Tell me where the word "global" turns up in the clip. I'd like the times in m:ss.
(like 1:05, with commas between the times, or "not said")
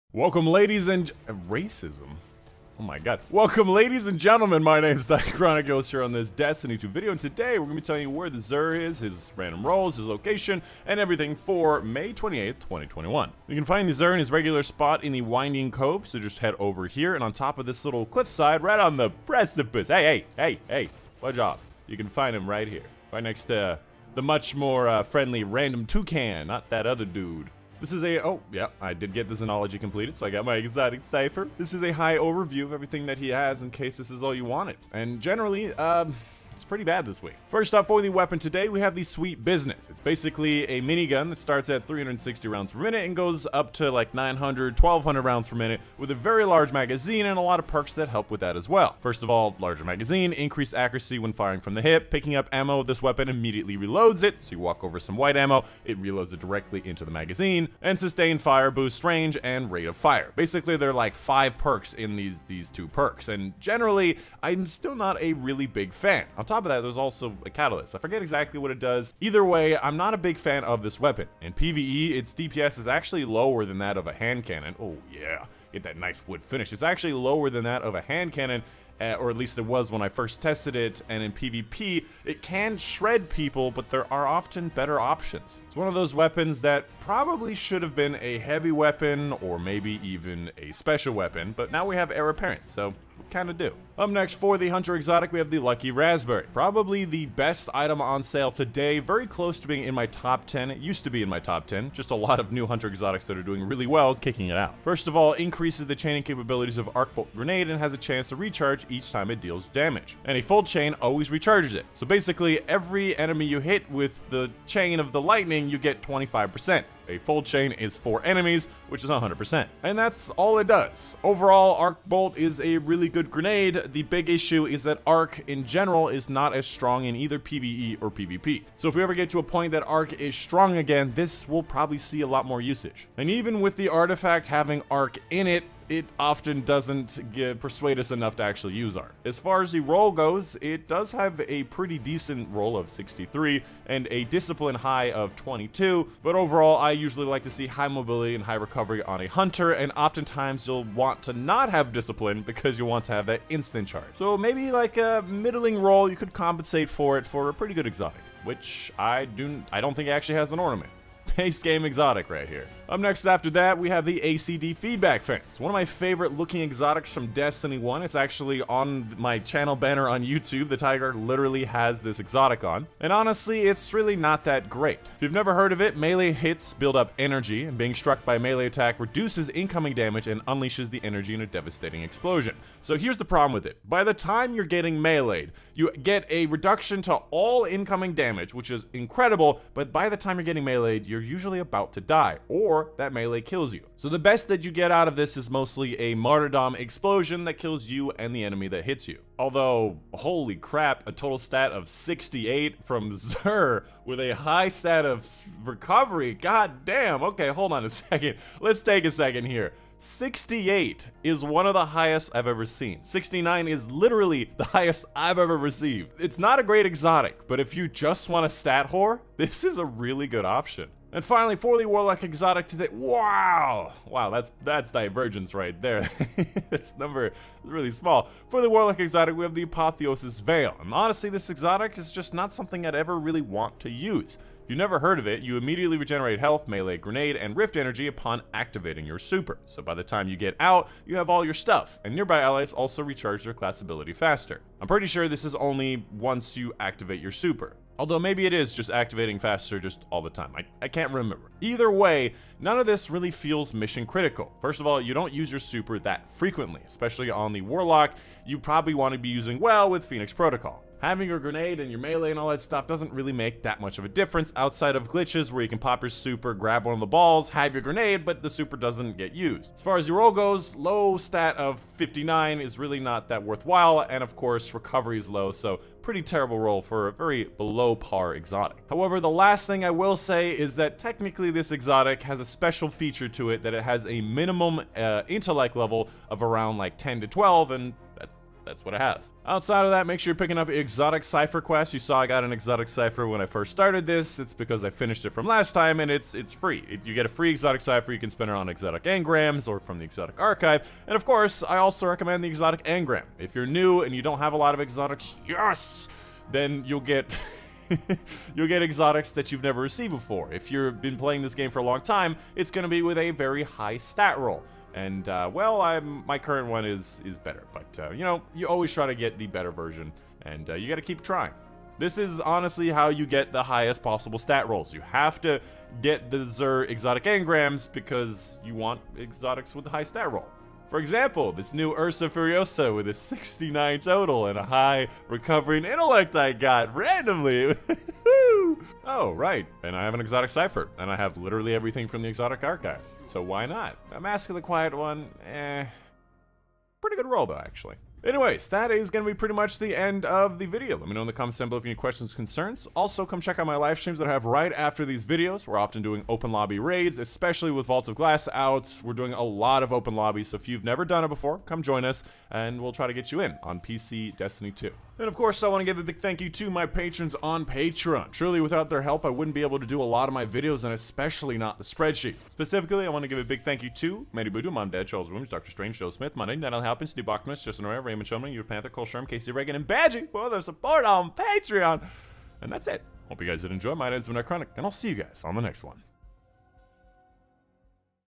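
not said.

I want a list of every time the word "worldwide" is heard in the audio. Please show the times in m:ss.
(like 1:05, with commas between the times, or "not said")
not said.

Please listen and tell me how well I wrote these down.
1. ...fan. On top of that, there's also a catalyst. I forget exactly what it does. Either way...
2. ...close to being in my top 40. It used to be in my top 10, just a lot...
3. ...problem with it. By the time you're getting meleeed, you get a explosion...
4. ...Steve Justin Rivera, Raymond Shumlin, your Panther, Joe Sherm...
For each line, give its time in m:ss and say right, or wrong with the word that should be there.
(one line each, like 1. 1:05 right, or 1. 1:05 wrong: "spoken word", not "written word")
1. 1:05 right
2. 1:39 wrong: "10", not "40"
3. 3:03 wrong: "reduction", not "explosion"
4. 6:17 wrong: "Cole", not "Joe".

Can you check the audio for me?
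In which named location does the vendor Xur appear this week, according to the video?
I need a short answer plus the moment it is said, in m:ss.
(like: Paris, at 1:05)
Winding Cove, at 0:15.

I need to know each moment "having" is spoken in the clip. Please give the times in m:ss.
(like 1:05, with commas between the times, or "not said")
2:14, 4:21.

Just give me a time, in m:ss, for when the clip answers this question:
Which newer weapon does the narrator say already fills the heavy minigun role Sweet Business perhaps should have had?
1:32.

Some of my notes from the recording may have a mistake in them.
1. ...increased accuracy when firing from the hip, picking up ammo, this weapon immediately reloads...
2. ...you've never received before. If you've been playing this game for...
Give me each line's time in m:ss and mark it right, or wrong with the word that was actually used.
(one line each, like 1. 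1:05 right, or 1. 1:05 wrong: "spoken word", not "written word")
1. 0:50 right
2. 5:09 right.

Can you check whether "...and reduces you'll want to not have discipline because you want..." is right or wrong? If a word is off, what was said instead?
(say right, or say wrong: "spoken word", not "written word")
wrong: "oftentimes", not "reduces".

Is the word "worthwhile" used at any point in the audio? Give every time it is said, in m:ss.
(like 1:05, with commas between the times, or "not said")
4:33.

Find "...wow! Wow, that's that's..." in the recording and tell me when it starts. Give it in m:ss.
3:42.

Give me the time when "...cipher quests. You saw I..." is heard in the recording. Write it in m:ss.
4:51.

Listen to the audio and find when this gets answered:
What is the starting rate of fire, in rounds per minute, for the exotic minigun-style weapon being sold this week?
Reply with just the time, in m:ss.
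0:41.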